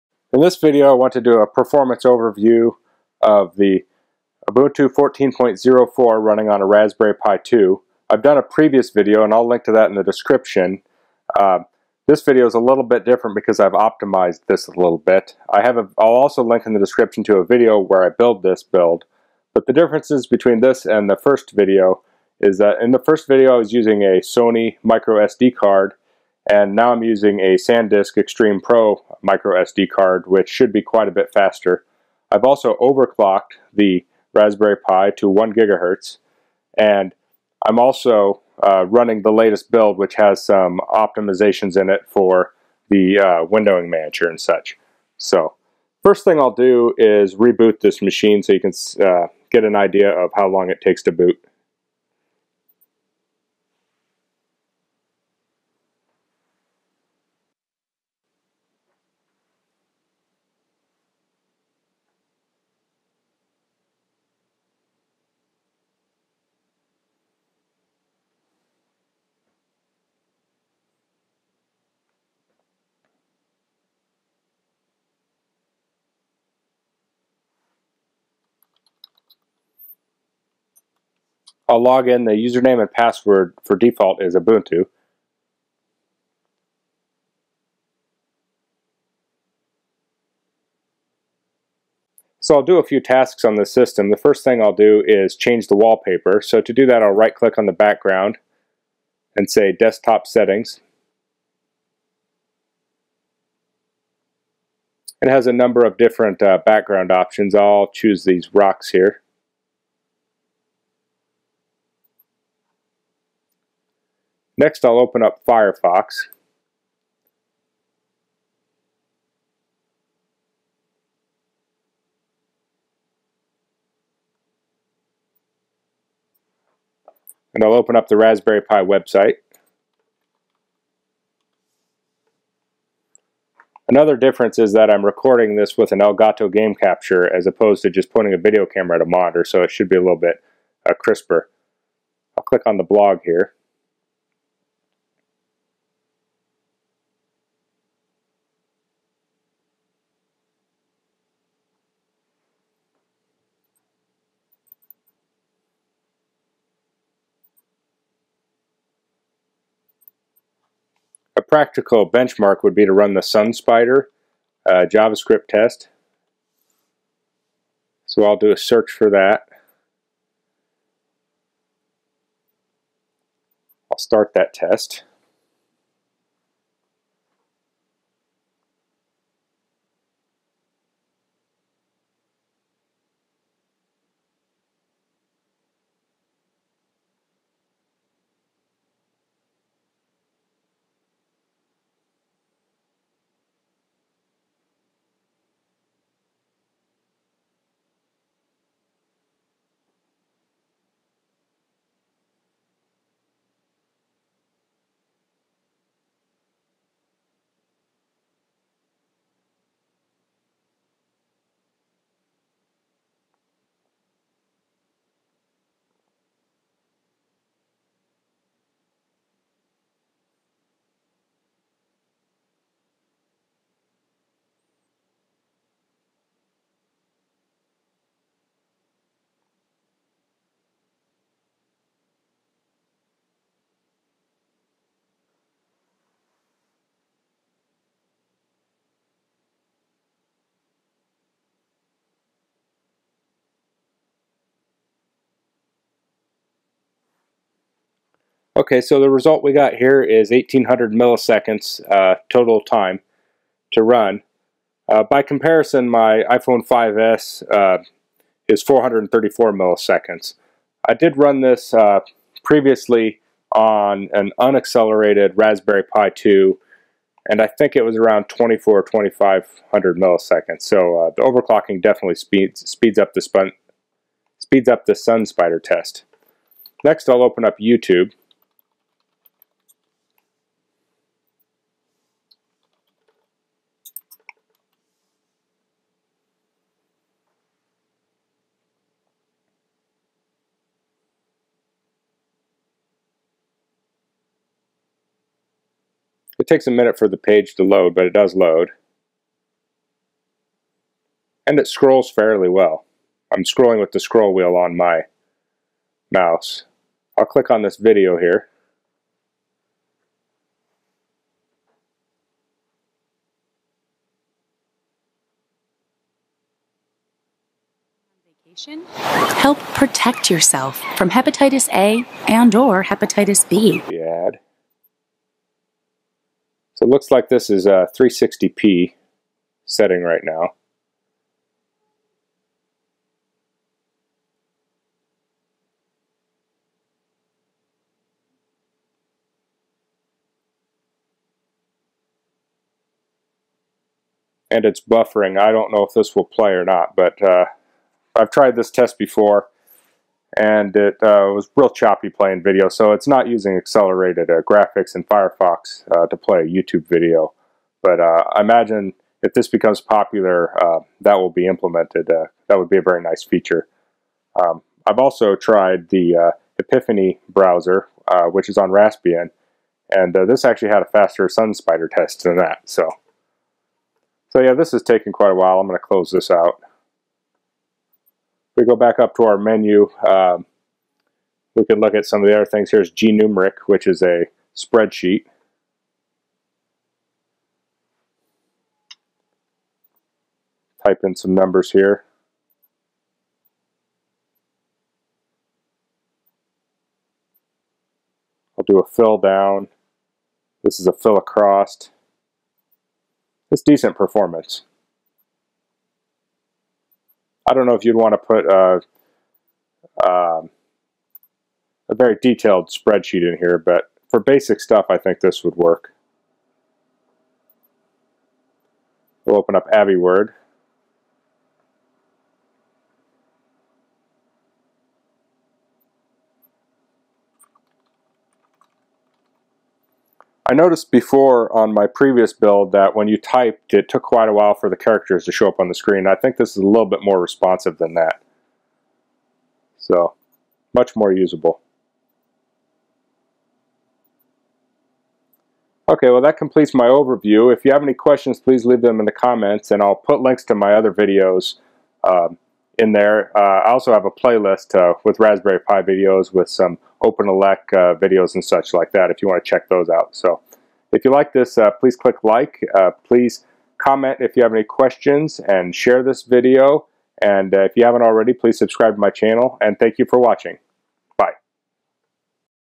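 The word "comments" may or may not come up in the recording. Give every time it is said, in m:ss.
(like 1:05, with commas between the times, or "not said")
7:29, 7:43.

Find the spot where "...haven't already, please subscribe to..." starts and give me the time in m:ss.
7:47.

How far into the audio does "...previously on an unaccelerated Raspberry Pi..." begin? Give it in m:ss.
4:22.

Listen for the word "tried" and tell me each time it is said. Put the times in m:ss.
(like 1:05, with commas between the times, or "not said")
5:48, 6:05.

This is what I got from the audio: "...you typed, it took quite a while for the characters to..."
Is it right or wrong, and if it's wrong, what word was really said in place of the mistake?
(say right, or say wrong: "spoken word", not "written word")
right.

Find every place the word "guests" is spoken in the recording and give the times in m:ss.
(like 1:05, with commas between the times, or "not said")
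not said.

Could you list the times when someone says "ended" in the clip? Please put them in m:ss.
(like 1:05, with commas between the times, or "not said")
not said.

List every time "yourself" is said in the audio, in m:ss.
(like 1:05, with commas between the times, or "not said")
5:20.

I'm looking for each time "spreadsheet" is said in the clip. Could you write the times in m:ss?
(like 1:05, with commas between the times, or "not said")
6:24, 6:52.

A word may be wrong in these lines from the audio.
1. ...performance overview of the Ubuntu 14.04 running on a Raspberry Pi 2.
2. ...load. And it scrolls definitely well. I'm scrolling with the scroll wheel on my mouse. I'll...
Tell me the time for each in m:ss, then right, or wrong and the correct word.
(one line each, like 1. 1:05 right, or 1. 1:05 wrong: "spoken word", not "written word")
1. 0:01 right
2. 4:58 wrong: "fairly", not "definitely".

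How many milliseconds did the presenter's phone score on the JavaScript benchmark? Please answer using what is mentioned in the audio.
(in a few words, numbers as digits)
434.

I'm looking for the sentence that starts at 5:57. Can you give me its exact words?
But uh, I imagine if this becomes popular, uh, that will be implemented.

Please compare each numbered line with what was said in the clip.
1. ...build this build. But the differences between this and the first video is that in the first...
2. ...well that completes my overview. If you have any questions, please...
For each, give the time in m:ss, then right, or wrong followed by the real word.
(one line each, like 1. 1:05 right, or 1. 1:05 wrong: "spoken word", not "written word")
1. 0:18 right
2. 7:26 right.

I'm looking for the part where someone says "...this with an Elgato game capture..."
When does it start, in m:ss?
2:15.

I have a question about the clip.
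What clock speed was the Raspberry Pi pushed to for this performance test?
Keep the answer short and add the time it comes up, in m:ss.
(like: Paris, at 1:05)
1 gigahertz, at 0:35.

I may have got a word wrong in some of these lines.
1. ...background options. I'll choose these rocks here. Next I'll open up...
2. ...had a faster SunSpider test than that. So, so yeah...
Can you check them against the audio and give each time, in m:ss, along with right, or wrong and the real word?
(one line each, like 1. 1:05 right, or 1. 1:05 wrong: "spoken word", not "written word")
1. 1:46 right
2. 6:10 right.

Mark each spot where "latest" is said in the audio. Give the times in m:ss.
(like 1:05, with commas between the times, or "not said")
0:39.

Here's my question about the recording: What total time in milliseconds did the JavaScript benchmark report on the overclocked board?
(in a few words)
1800 milliseconds.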